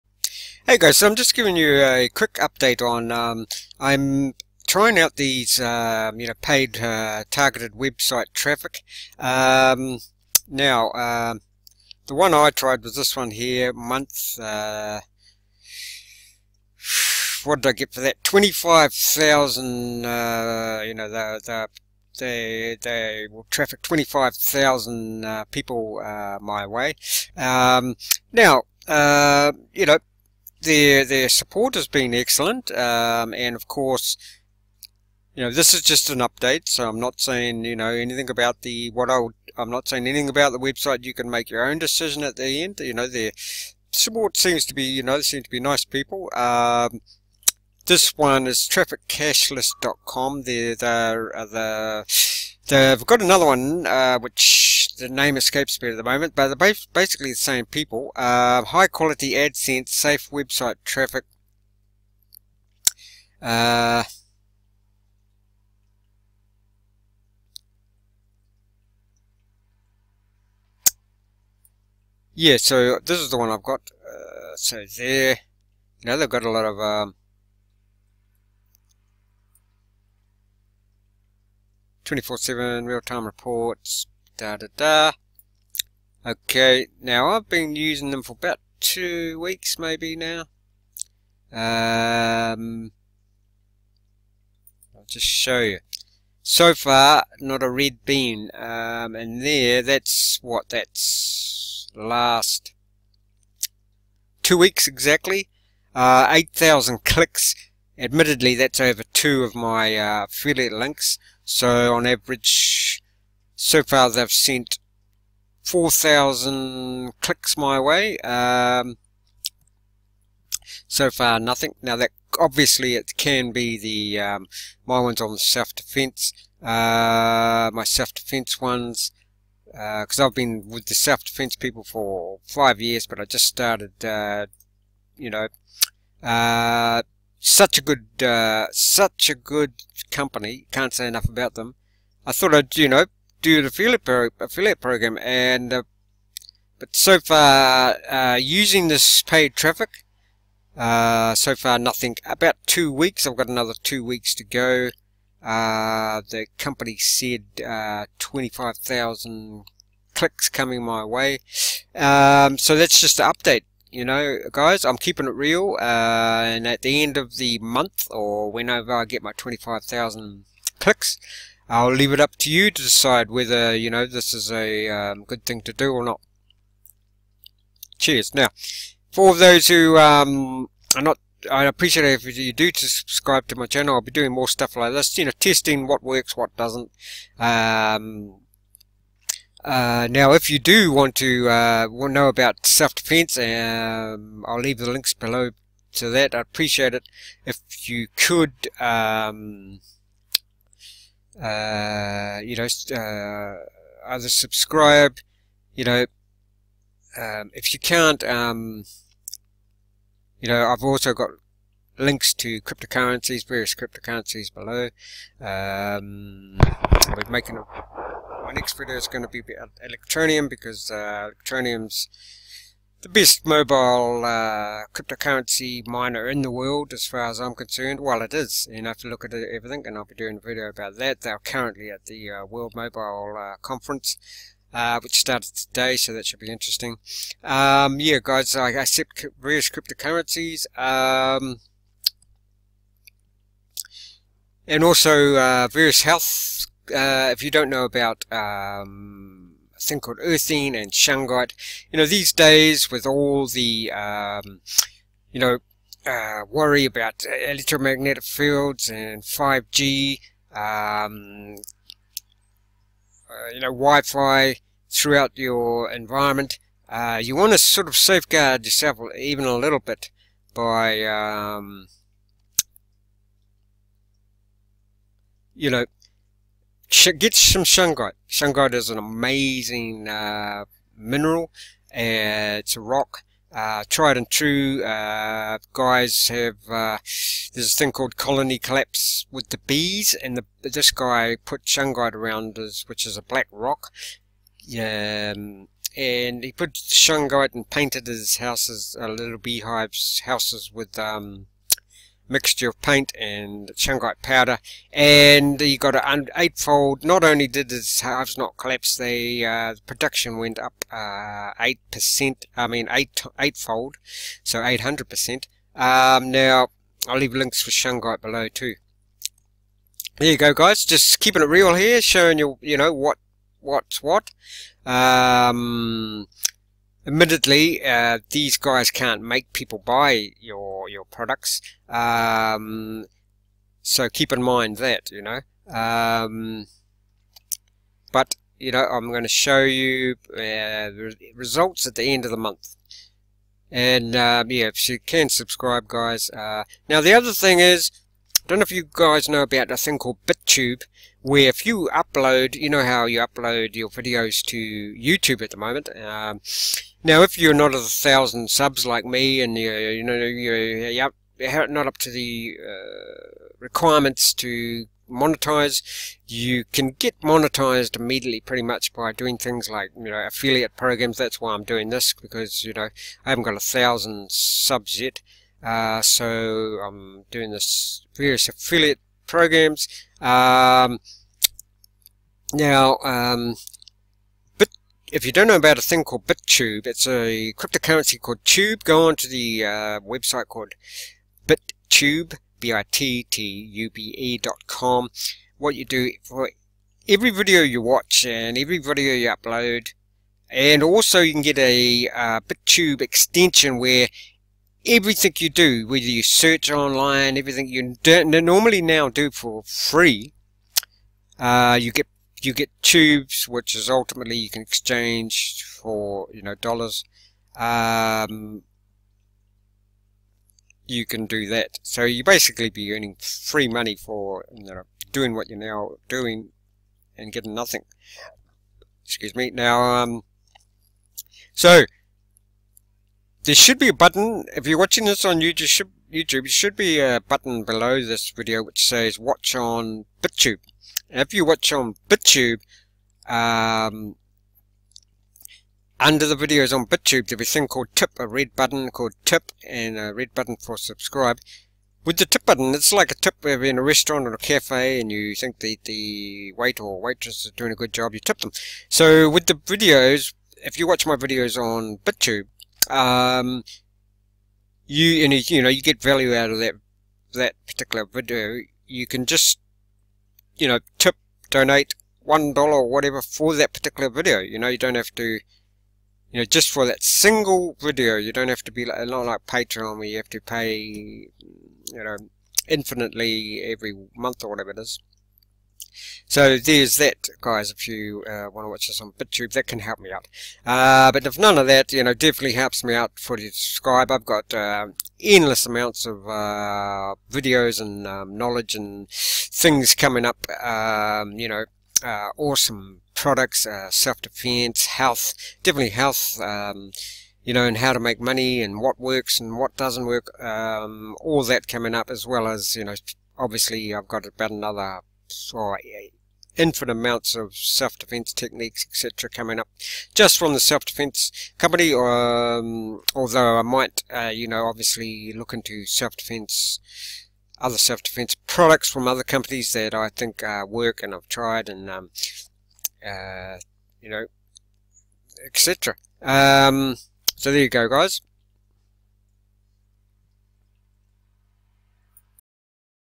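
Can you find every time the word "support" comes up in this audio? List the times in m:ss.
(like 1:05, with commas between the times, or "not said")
0:31, 0:43.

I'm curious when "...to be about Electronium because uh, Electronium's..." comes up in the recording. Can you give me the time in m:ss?
3:39.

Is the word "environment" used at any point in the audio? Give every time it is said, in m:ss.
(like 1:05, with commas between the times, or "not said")
4:25.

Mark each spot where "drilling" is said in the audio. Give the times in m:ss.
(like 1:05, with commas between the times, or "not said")
not said.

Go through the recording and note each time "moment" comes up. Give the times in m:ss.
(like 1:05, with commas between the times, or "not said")
0:56, 5:55.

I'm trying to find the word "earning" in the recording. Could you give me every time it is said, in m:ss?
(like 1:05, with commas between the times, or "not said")
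7:02.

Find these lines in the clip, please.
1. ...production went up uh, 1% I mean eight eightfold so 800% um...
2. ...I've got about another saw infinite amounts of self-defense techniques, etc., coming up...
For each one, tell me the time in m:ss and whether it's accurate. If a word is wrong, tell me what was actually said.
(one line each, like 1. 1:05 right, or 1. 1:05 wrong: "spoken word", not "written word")
1. 5:09 wrong: "8", not "1"
2. 8:33 right.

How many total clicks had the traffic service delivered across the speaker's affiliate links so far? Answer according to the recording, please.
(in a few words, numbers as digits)
8,000.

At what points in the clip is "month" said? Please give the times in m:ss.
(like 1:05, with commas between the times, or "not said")
0:13, 2:47, 5:42, 8:04.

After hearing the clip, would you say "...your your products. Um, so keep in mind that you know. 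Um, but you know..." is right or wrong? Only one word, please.
right.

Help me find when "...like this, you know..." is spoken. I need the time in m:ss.
3:04.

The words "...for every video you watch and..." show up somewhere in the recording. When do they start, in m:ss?
6:36.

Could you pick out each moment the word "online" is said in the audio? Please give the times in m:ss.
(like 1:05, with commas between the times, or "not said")
6:46.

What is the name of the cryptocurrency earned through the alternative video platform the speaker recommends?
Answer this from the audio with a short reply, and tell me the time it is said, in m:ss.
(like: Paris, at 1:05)
Tube, at 6:28.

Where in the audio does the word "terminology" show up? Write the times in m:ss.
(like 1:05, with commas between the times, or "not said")
not said.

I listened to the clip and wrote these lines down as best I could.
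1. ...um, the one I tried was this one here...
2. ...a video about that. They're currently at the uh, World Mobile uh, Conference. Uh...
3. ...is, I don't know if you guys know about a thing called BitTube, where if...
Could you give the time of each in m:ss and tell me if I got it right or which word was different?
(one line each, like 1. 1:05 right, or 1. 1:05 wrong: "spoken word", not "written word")
1. 0:10 right
2. 3:50 right
3. 5:47 right.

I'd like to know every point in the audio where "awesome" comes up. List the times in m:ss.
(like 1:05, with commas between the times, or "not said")
8:22.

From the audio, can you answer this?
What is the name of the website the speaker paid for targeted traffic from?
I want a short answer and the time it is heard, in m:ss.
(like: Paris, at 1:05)
trafficcashlist.com, at 0:48.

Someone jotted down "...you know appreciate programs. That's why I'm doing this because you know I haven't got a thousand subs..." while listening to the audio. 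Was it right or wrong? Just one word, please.
wrong.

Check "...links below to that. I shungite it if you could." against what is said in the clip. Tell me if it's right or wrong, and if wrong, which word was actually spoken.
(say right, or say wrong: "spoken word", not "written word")
wrong: "appreciate", not "shungite".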